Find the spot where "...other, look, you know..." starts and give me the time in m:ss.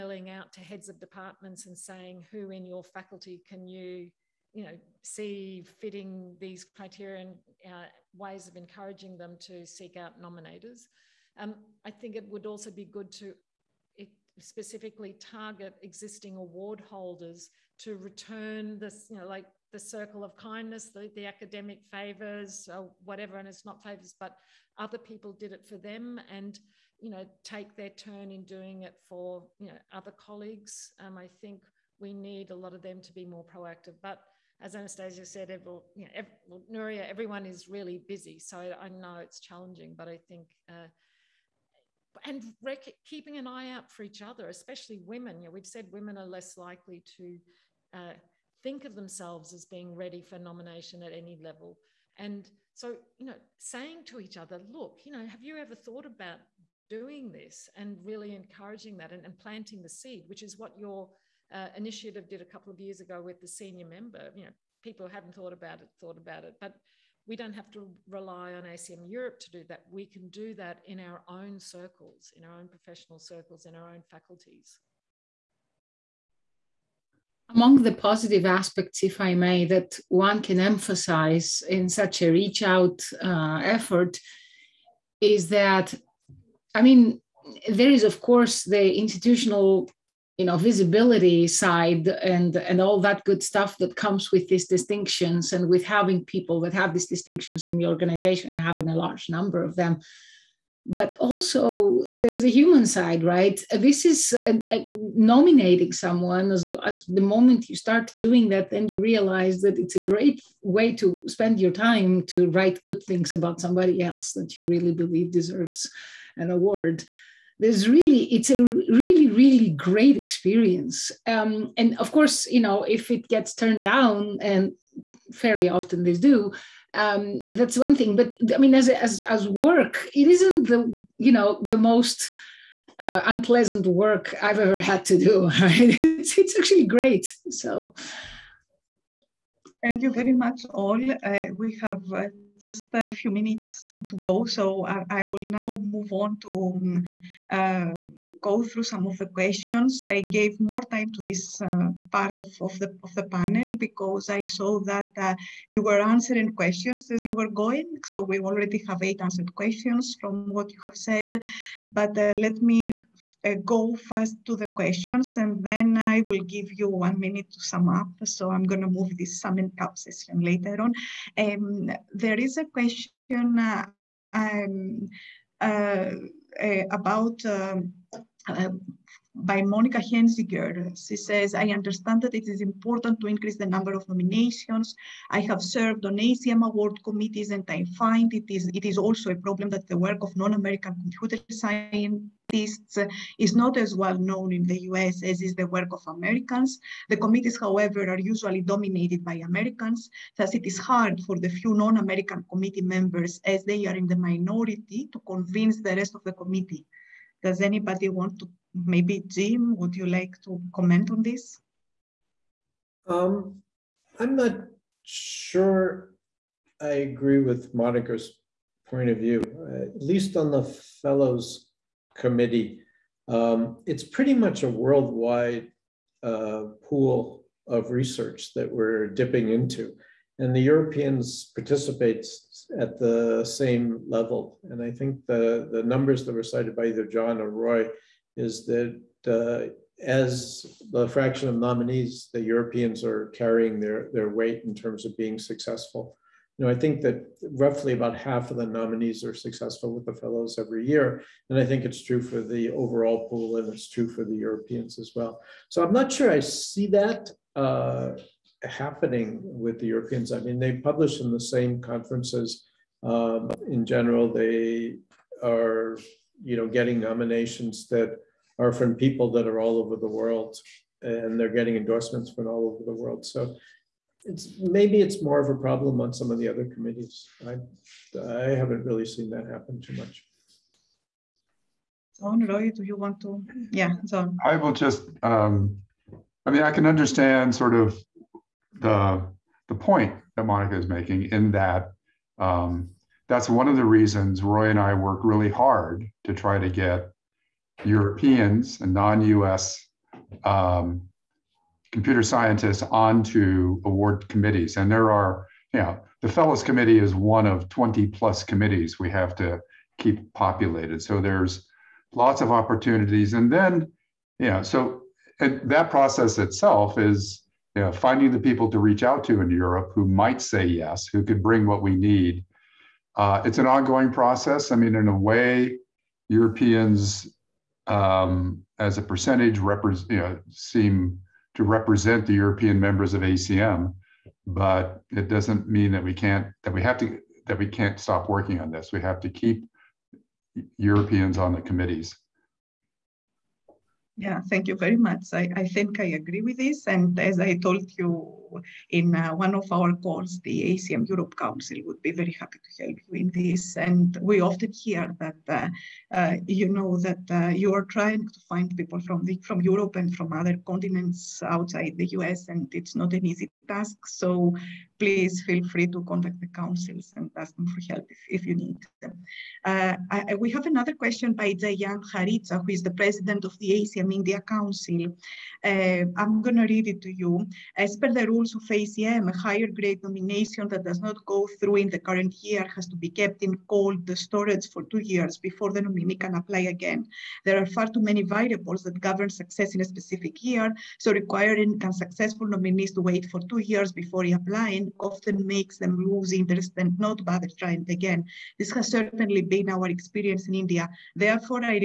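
0:54.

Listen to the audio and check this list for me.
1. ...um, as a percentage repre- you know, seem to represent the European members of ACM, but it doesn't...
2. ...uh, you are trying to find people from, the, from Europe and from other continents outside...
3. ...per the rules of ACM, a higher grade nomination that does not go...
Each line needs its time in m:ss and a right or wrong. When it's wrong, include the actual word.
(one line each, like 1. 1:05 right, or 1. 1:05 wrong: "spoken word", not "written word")
1. 5:27 right
2. 5:57 right
3. 6:17 right.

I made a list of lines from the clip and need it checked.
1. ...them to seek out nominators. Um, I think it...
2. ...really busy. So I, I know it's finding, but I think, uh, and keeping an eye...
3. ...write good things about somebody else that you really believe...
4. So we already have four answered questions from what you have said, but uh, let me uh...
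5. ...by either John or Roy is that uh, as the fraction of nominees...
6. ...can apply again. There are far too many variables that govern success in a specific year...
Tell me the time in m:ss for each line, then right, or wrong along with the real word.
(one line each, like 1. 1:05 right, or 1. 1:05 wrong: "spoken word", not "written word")
1. 0:09 right
2. 0:37 wrong: "challenging", not "finding"
3. 1:52 right
4. 2:38 wrong: "eight", not "four"
5. 3:56 right
6. 6:26 right.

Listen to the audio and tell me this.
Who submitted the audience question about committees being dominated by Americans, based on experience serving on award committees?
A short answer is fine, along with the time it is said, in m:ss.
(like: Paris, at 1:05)
Monika Henzinger, at 2:59.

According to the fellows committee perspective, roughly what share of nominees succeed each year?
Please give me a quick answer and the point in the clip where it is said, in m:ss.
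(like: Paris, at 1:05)
about half, at 4:07.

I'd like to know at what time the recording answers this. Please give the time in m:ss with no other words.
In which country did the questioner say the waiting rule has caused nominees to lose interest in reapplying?
6:40.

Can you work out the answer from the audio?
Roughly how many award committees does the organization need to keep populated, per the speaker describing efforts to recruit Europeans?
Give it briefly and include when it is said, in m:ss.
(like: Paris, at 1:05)
20 plus, at 5:07.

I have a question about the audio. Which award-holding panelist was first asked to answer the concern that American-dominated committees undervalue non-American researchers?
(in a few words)
Jim.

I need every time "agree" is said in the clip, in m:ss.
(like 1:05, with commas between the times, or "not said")
3:37, 5:46.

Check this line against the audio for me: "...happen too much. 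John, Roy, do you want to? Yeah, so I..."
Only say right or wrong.
right.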